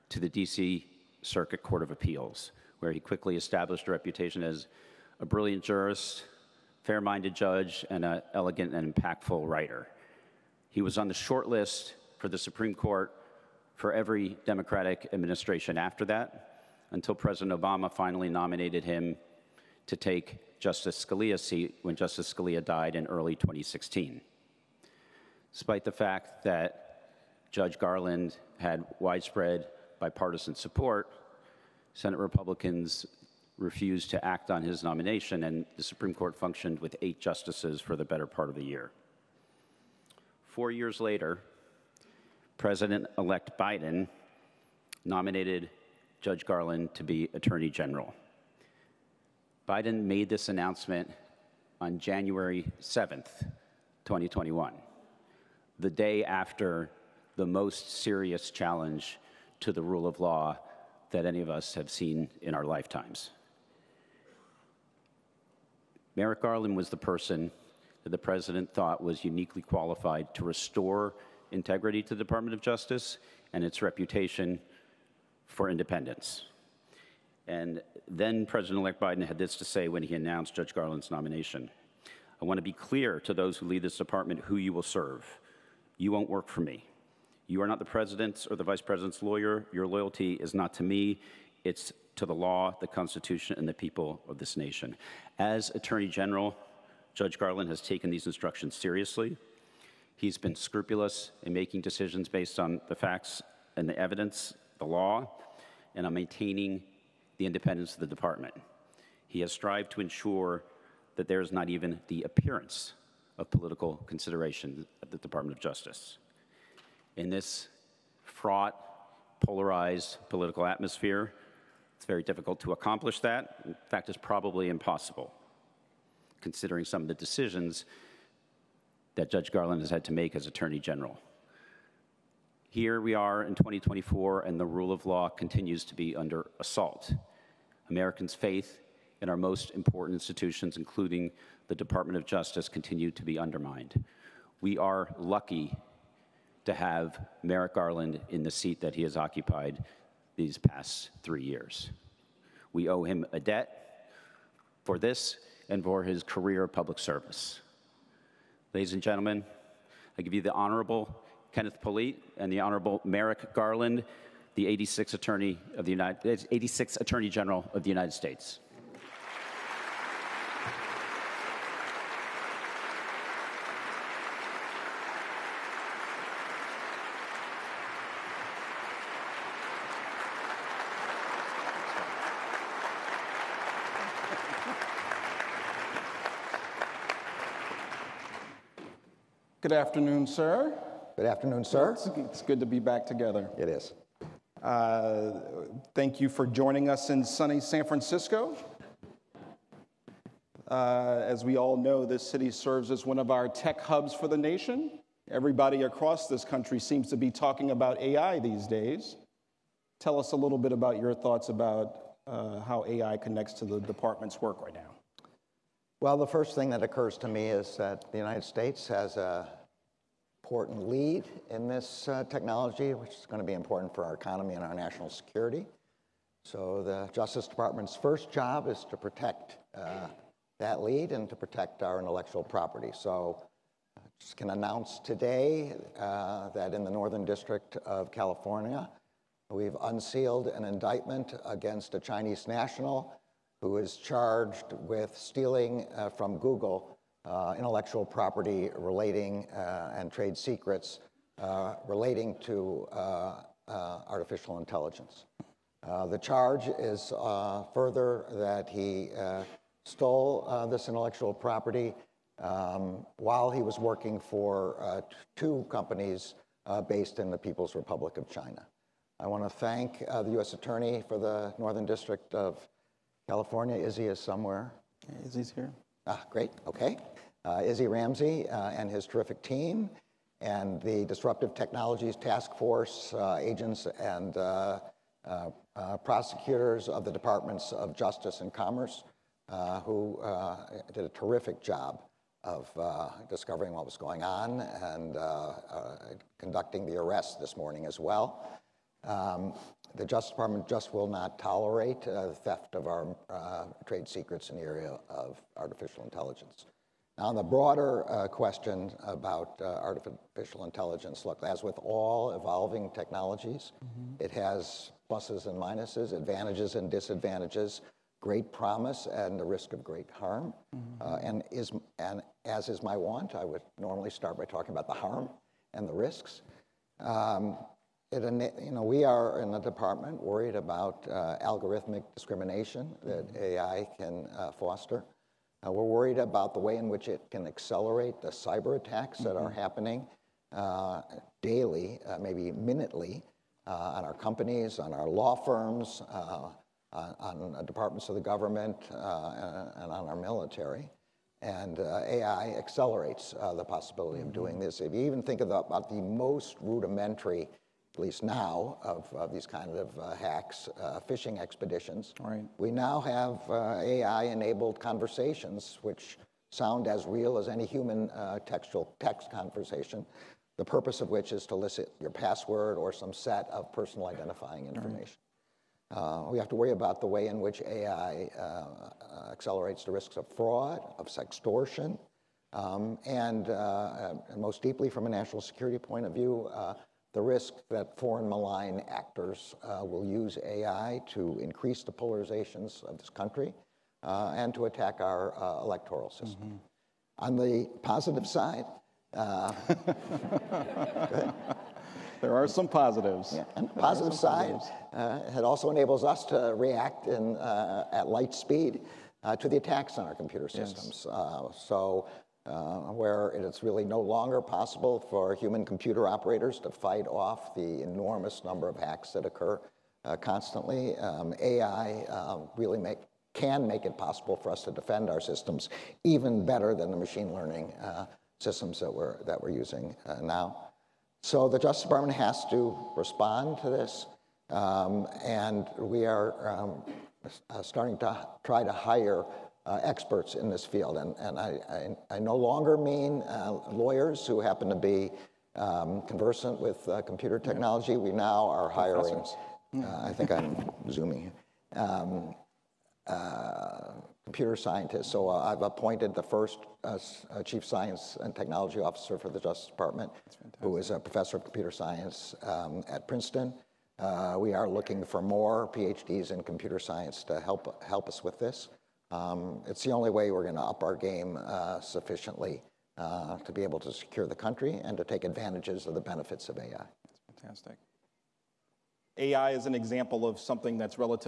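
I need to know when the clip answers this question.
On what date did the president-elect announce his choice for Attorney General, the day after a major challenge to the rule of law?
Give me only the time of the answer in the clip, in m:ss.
0:51.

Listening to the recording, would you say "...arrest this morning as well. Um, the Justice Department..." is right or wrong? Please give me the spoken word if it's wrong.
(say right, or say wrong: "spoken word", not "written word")
right.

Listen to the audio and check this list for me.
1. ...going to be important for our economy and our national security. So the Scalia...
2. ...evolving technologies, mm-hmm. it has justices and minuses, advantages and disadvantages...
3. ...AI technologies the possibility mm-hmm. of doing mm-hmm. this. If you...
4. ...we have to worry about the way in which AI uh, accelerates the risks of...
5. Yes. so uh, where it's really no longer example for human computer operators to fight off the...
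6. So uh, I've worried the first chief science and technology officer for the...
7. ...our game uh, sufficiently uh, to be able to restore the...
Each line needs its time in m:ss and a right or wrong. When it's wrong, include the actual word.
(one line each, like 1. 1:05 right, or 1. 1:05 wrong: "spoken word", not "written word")
1. 3:43 wrong: "Justice", not "Scalia"
2. 5:12 wrong: "pluses", not "justices"
3. 5:51 wrong: "accelerates", not "technologies"
4. 6:16 right
5. 6:51 wrong: "possible", not "example"
6. 7:35 wrong: "appointed", not "worried"
7. 7:50 wrong: "secure", not "restore".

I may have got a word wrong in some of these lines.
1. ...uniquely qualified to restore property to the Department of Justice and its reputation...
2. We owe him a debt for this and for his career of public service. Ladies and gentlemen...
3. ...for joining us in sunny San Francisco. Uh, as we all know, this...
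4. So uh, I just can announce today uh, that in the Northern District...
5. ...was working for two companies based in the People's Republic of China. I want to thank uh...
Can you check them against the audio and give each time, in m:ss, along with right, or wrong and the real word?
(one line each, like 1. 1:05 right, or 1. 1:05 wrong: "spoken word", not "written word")
1. 1:09 wrong: "integrity", not "property"
2. 2:32 right
3. 3:16 right
4. 3:52 right
5. 4:23 right.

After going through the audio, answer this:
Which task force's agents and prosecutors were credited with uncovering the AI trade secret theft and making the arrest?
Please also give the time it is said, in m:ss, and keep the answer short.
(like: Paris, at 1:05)
Disruptive Technologies Task Force, at 4:41.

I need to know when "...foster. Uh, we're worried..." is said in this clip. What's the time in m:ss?
5:34.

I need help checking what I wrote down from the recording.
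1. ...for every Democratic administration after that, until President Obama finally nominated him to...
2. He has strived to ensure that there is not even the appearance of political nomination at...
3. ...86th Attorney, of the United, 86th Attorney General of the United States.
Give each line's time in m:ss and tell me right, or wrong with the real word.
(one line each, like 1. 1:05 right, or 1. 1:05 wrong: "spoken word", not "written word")
1. 0:13 right
2. 1:49 wrong: "consideration", not "nomination"
3. 2:44 right.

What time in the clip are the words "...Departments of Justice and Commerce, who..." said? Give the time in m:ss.
4:47.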